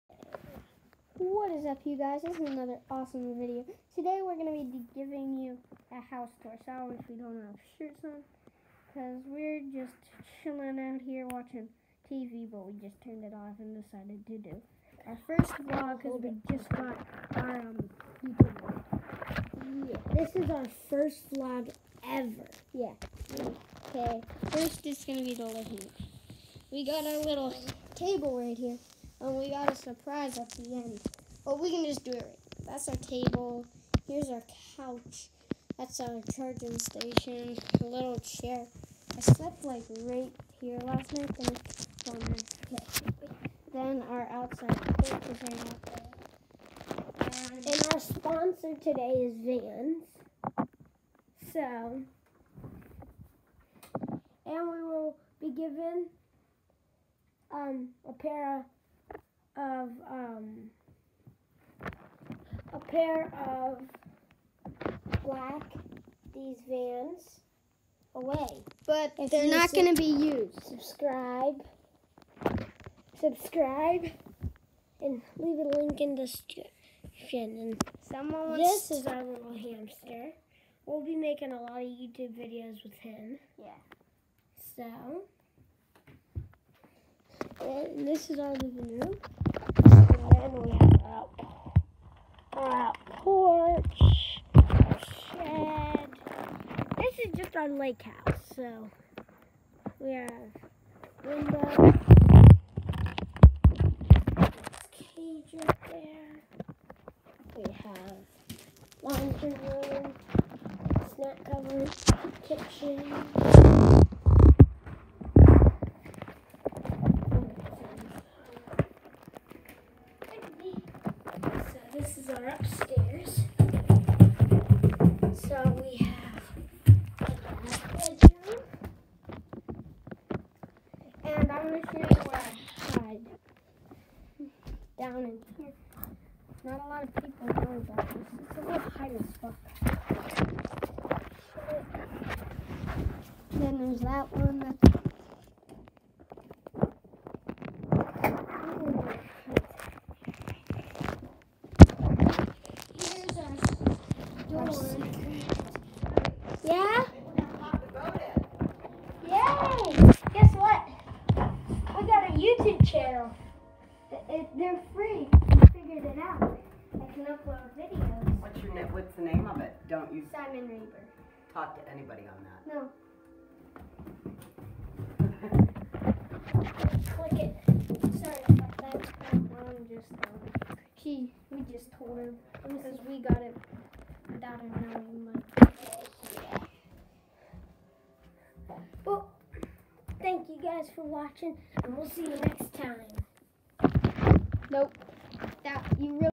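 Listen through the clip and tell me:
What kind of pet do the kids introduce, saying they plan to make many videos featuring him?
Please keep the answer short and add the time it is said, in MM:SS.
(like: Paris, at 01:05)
Hamster, at 01:19.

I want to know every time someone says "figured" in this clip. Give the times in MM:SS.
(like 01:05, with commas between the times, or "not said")
02:45.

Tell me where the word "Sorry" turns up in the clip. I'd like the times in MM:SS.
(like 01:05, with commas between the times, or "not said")
00:06, 02:58.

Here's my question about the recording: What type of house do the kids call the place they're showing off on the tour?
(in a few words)
Lake house.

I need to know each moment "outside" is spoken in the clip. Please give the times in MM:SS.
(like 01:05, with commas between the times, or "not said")
00:44.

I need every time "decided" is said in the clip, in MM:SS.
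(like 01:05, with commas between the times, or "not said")
00:13.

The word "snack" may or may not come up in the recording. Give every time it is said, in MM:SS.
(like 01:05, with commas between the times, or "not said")
01:51.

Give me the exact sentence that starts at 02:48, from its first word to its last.
What's your What's the name of it?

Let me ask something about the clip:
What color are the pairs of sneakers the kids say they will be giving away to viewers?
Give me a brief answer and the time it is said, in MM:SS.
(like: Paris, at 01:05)
Black, at 01:05.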